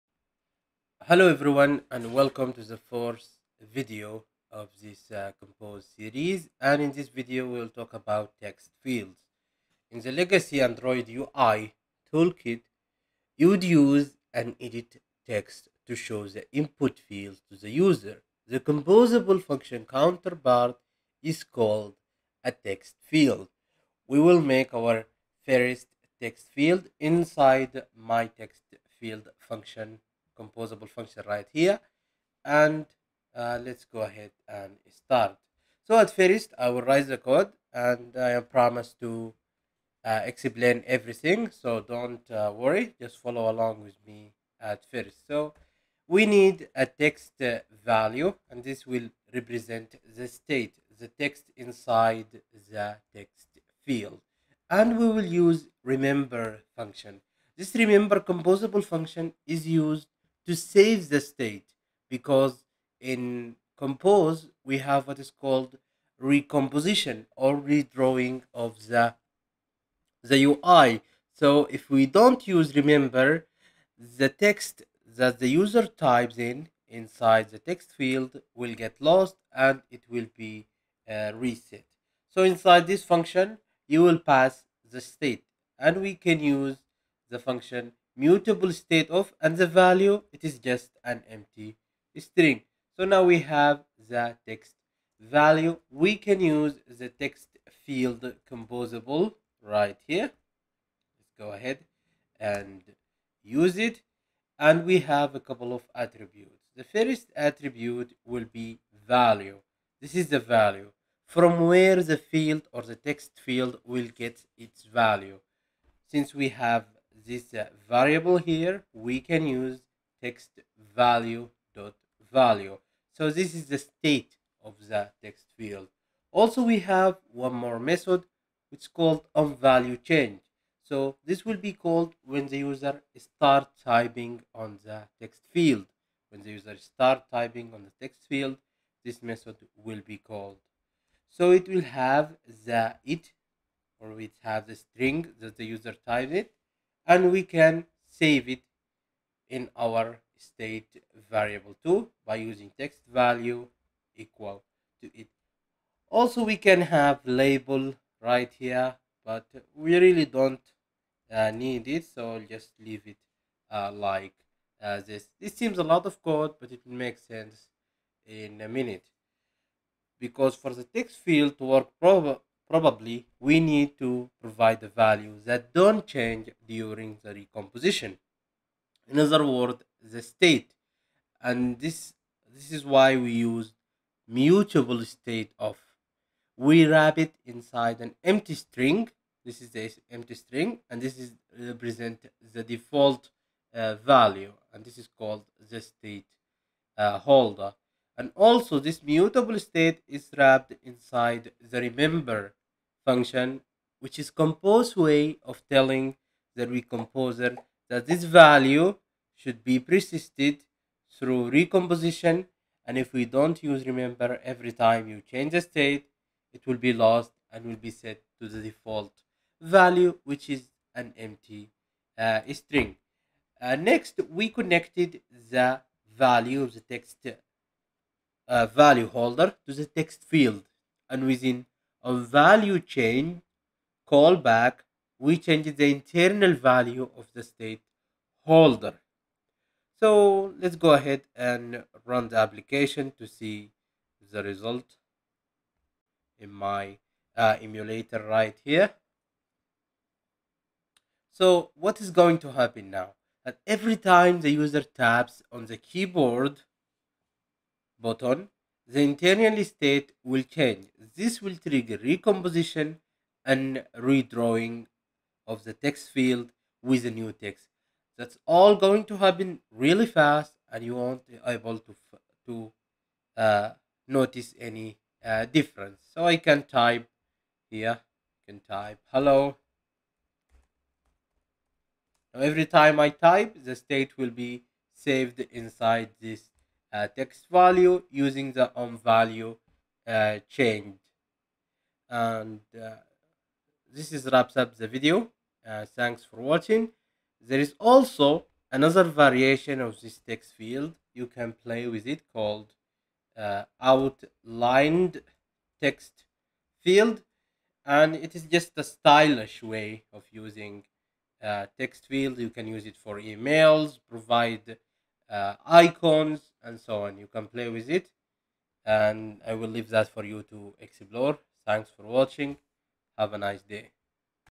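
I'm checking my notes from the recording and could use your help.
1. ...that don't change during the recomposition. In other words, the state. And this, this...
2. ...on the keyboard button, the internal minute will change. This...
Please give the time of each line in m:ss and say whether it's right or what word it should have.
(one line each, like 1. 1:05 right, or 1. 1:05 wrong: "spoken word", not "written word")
1. 2:55 right
2. 4:15 wrong: "state", not "minute".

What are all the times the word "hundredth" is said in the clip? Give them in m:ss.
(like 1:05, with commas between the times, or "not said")
not said.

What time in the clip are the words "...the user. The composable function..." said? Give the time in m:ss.
0:17.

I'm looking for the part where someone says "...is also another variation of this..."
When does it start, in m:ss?
4:57.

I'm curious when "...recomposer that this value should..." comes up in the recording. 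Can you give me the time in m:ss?
3:26.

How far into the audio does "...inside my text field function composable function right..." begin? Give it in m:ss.
0:27.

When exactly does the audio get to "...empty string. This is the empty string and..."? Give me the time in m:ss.
3:08.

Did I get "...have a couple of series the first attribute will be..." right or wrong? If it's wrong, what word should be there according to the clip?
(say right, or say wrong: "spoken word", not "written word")
wrong: "attributes", not "series".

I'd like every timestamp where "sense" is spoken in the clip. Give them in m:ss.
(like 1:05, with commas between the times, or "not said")
2:47.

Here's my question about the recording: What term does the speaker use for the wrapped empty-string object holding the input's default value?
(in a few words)
state holder.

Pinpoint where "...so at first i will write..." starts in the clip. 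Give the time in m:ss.
0:35.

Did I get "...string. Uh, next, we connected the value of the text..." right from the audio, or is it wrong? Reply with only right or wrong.
right.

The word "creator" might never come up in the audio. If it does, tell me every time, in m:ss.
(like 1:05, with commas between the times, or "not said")
not said.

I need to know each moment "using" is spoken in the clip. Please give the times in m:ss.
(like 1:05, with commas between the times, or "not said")
2:32, 4:48, 5:10.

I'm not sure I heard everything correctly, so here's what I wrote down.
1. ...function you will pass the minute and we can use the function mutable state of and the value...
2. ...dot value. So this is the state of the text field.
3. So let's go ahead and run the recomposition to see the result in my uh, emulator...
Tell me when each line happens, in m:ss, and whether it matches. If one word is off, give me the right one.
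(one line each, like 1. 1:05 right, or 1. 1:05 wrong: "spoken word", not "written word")
1. 1:23 wrong: "state", not "minute"
2. 2:01 right
3. 3:59 wrong: "application", not "recomposition".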